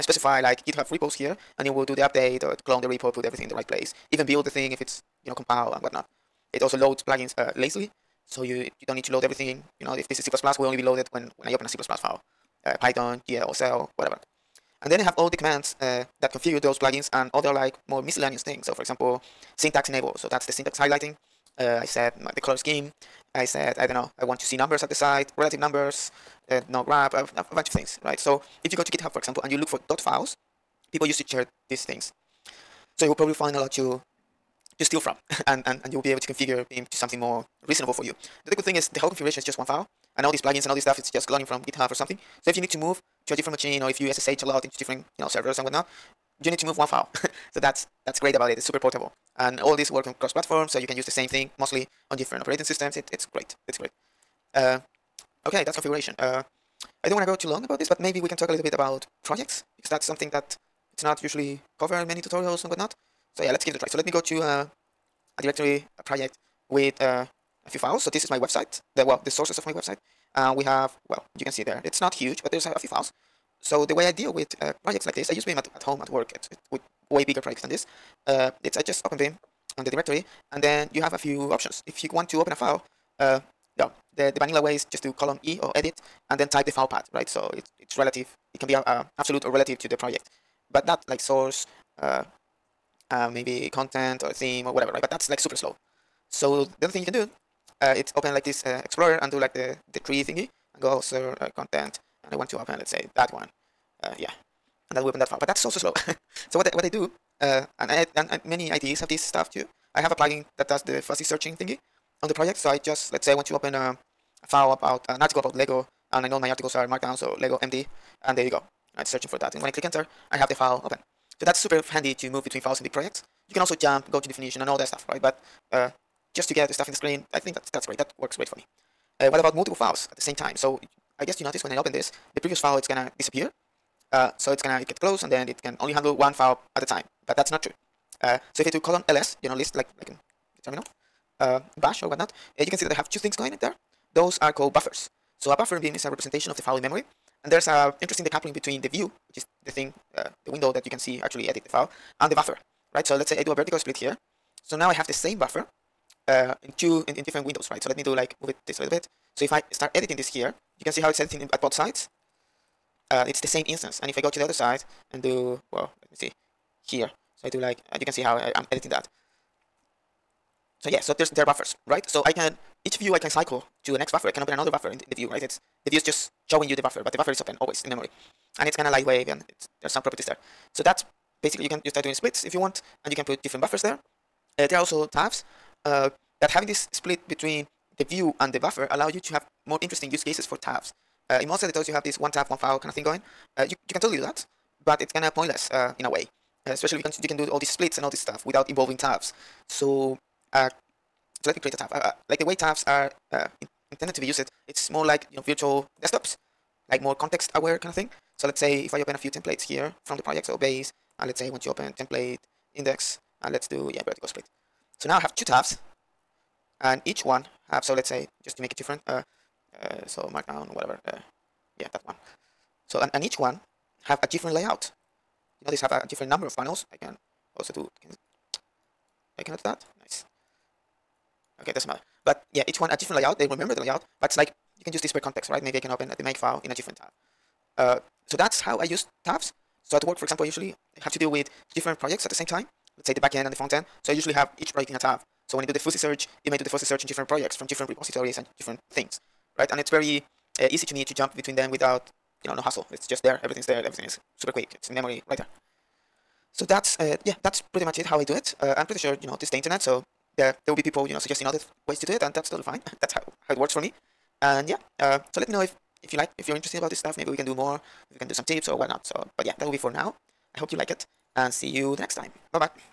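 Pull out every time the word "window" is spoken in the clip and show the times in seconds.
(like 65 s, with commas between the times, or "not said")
150 s, 157 s.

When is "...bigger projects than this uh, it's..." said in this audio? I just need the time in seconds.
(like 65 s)
77 s.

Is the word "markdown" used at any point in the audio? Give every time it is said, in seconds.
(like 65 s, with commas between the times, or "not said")
116 s, 220 s.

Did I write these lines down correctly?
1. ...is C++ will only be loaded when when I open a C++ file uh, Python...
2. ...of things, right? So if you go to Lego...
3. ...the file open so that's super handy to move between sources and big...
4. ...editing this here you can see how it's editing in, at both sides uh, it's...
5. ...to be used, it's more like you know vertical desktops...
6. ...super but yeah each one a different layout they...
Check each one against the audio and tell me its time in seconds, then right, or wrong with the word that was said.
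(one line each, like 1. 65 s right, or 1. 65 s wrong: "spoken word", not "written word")
1. 10 s right
2. 27 s wrong: "GitHub", not "Lego"
3. 120 s wrong: "files", not "sources"
4. 159 s right
5. 204 s wrong: "virtual", not "vertical"
6. 231 s wrong: "matter", not "super".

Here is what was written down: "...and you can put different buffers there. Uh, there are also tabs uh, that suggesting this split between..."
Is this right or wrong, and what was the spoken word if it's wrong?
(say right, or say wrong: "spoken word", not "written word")
wrong: "having", not "suggesting".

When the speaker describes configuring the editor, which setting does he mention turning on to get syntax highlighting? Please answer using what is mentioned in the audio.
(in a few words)
syntax enable.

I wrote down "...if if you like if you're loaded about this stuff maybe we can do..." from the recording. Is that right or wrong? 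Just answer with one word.
wrong.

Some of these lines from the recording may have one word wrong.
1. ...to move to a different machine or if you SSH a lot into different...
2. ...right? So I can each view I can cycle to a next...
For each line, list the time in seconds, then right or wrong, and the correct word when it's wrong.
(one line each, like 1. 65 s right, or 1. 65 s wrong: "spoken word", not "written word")
1. 42 s right
2. 171 s right.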